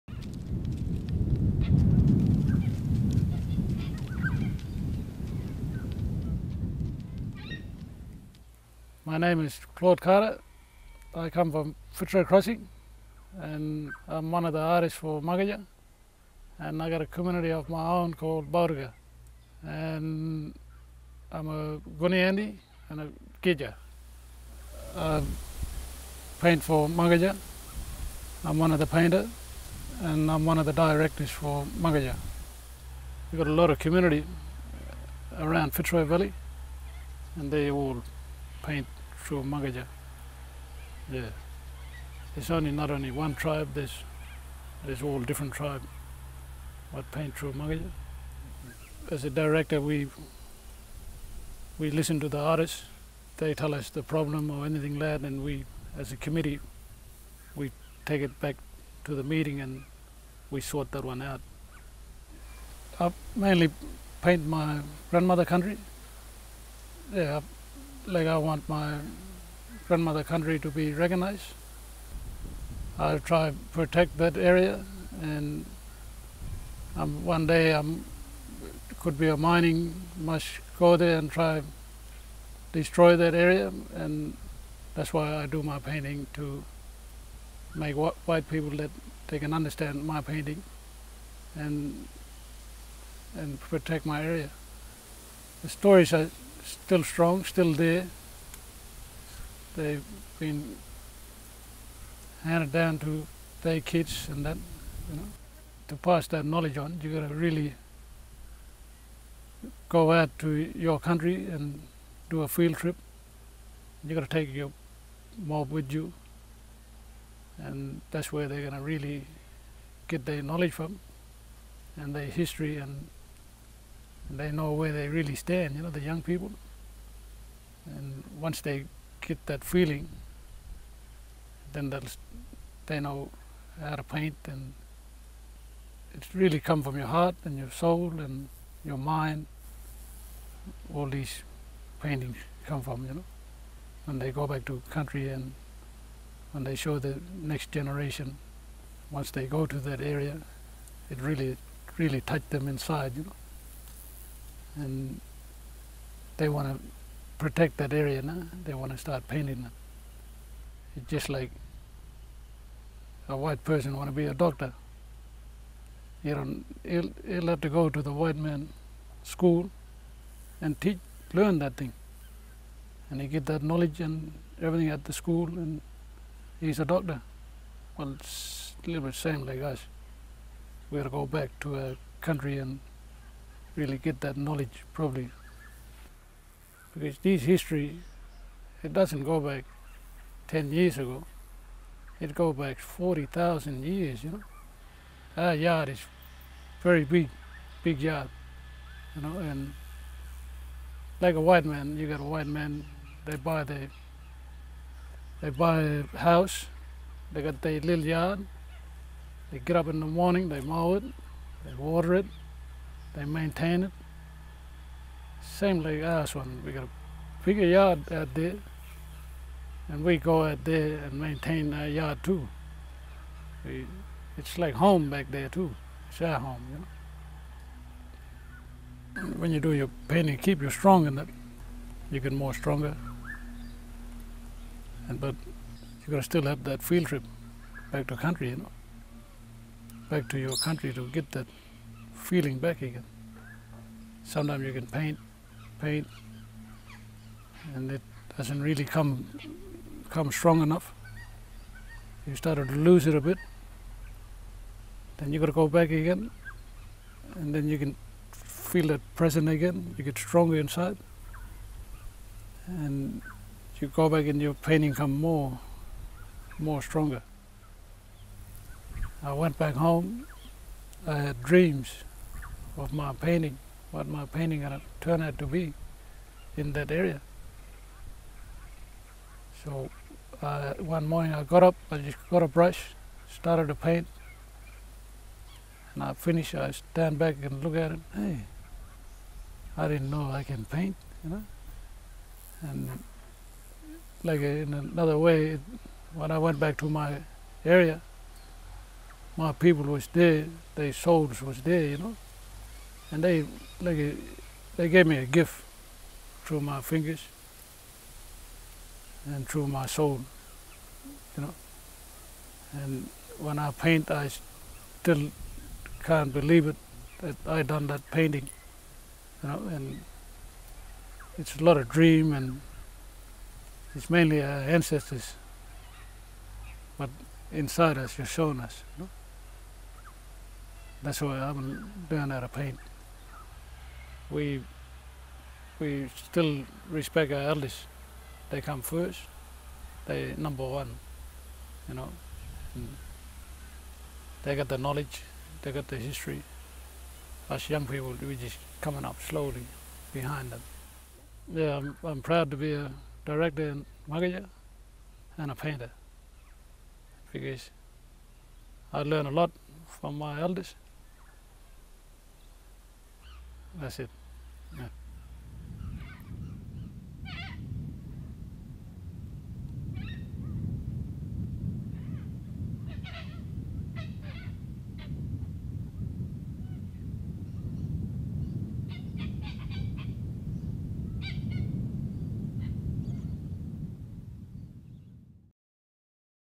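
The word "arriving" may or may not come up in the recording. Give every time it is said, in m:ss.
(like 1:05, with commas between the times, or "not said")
not said.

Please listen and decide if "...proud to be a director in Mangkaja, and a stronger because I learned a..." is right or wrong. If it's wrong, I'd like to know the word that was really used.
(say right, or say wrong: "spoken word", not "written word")
wrong: "painter", not "stronger".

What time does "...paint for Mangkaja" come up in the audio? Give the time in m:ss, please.
0:26.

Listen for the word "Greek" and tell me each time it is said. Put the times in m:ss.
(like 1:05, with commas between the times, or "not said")
not said.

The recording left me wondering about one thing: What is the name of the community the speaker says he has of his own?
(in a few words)
Bauruga.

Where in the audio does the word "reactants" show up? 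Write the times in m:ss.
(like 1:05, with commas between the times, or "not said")
not said.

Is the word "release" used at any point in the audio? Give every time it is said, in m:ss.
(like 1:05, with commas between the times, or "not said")
not said.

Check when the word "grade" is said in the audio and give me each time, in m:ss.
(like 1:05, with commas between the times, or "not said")
not said.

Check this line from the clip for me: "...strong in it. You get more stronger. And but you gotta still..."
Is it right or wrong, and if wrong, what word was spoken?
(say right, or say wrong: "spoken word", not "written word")
right.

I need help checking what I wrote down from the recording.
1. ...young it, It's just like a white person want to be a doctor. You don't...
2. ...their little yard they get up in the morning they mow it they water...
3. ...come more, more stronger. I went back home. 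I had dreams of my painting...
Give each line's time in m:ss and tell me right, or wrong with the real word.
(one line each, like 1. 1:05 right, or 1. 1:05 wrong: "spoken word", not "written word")
1. 2:39 wrong: "painting", not "young"
2. 3:27 right
3. 4:24 right.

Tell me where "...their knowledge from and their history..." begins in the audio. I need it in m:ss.
2:00.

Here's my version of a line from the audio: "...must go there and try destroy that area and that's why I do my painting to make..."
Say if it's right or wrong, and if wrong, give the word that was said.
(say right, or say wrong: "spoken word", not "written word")
right.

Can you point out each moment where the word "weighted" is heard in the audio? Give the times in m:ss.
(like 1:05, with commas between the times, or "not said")
not said.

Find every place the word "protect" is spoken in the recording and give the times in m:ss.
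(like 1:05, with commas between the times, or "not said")
1:13, 1:33, 2:37.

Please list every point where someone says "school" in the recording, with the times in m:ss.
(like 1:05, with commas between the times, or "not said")
2:49, 2:55.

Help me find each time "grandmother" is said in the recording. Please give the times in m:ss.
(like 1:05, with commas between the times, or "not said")
1:05, 1:09.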